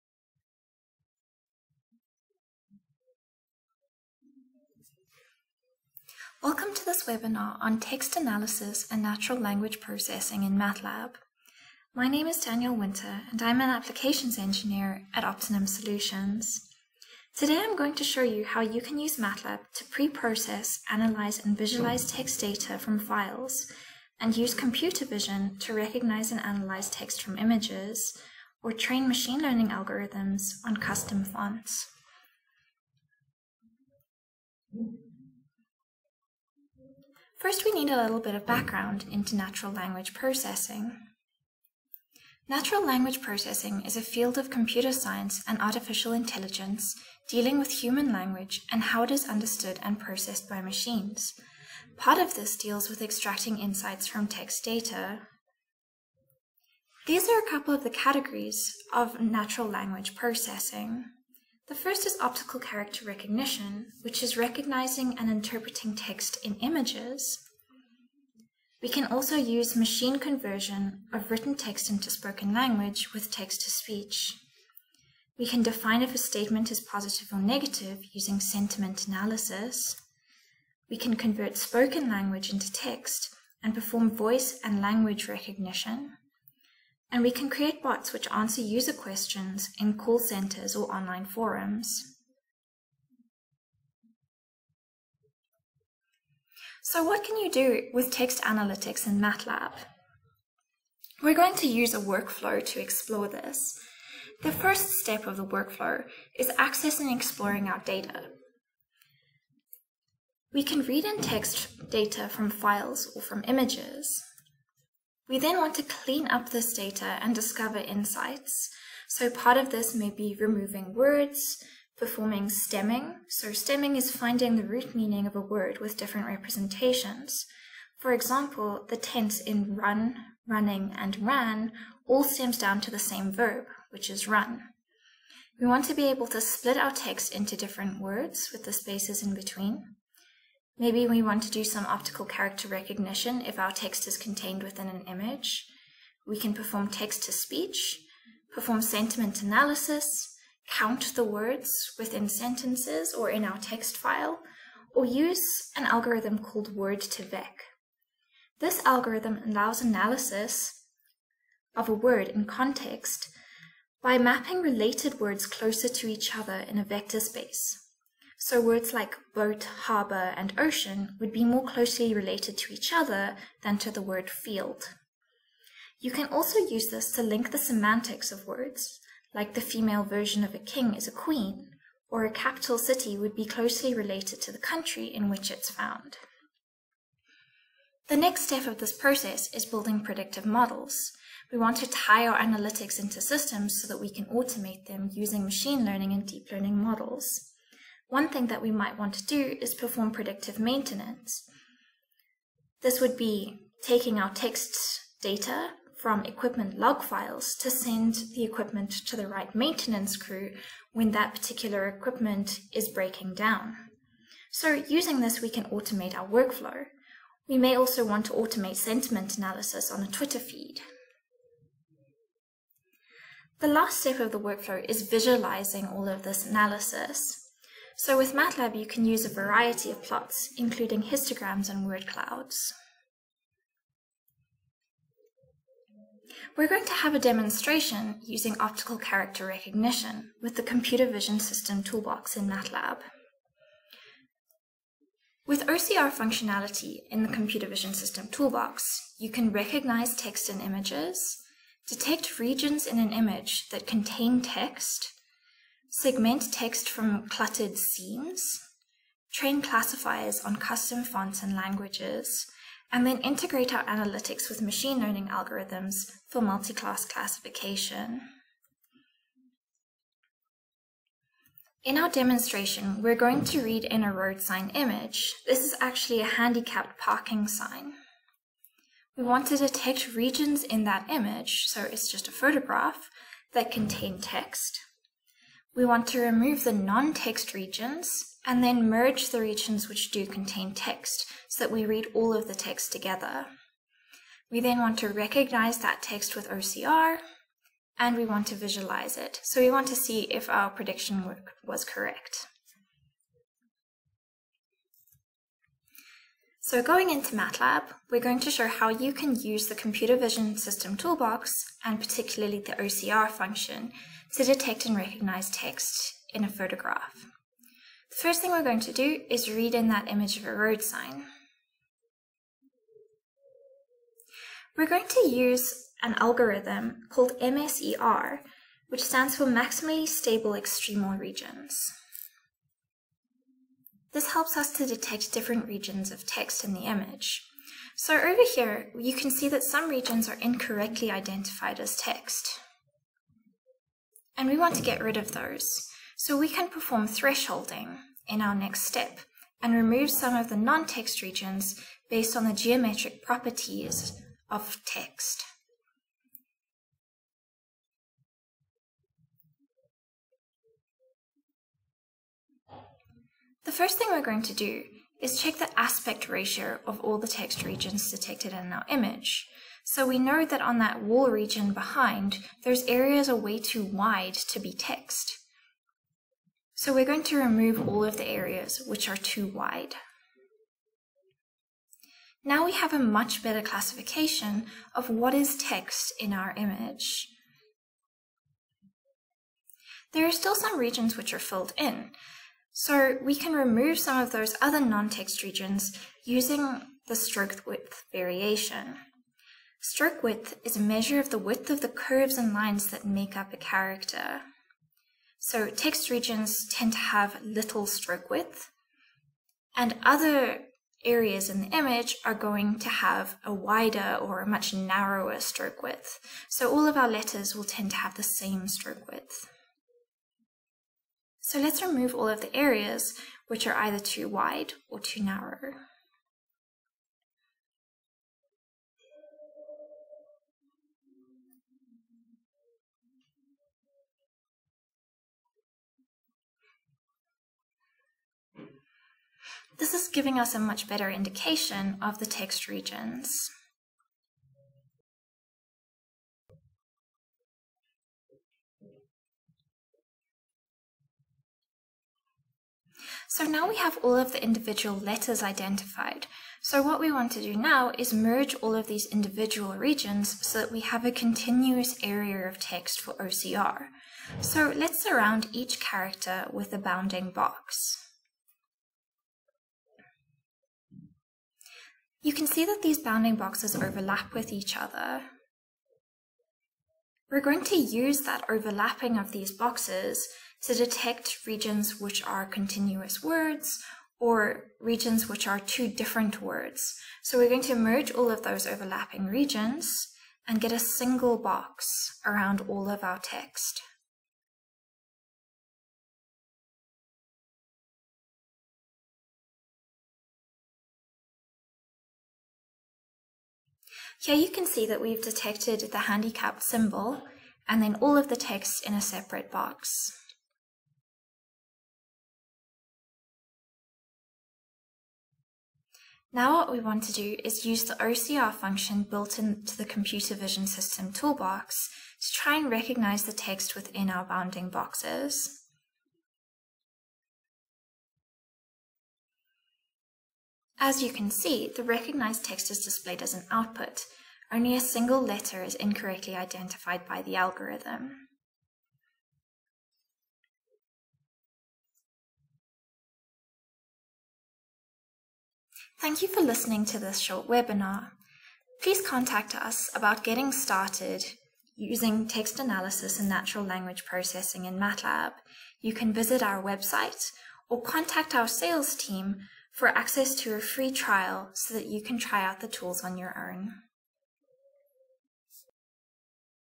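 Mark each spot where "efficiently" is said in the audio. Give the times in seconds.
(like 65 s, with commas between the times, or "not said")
not said.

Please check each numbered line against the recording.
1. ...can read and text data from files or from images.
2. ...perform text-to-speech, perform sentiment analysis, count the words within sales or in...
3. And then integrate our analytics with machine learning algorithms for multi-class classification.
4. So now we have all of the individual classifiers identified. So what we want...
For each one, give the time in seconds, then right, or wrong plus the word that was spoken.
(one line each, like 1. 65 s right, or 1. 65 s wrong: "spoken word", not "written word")
1. 110 s right
2. 146 s wrong: "sentences", not "sales"
3. 262 s right
4. 453 s wrong: "letters", not "classifiers".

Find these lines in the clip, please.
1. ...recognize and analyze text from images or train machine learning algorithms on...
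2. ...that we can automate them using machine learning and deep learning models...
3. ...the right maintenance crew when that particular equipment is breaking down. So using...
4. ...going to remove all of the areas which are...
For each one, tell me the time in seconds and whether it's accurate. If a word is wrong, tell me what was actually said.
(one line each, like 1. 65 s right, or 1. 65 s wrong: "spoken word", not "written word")
1. 25 s right
2. 193 s right
3. 209 s right
4. 377 s right.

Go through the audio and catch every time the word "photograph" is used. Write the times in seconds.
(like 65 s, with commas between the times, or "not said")
282 s, 316 s.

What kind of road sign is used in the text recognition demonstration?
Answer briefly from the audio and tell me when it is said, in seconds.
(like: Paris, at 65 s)
handicapped parking sign, at 276 s.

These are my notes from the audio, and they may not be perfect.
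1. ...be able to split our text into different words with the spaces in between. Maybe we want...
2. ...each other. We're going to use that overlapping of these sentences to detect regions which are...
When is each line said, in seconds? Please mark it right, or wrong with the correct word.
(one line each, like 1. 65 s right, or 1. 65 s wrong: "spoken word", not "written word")
1. 135 s right
2. 474 s wrong: "boxes", not "sentences".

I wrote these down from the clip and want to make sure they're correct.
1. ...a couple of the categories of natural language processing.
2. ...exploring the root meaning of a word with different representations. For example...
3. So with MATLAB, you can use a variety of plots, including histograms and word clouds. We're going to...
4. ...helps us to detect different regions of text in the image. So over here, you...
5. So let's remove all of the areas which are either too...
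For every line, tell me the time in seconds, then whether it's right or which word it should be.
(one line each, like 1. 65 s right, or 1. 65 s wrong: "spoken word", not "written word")
1. 57 s right
2. 124 s wrong: "finding", not "exploring"
3. 227 s right
4. 334 s right
5. 421 s right.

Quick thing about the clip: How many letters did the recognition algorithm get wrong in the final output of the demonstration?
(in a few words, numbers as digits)
1.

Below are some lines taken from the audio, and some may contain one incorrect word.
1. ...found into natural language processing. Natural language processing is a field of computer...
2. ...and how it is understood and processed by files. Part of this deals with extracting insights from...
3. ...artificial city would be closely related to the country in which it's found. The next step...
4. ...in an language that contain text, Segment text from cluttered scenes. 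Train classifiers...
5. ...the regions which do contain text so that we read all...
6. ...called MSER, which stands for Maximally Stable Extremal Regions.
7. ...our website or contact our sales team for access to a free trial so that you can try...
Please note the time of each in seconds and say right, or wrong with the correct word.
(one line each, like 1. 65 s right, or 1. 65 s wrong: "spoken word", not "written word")
1. 38 s wrong: "background", not "found"
2. 48 s wrong: "machines", not "files"
3. 182 s wrong: "capital", not "artificial"
4. 252 s wrong: "image", not "language"
5. 289 s right
6. 327 s right
7. 556 s right.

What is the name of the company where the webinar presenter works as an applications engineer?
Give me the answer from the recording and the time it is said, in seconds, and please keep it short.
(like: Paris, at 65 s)
Opti-Num Solutions, at 15 s.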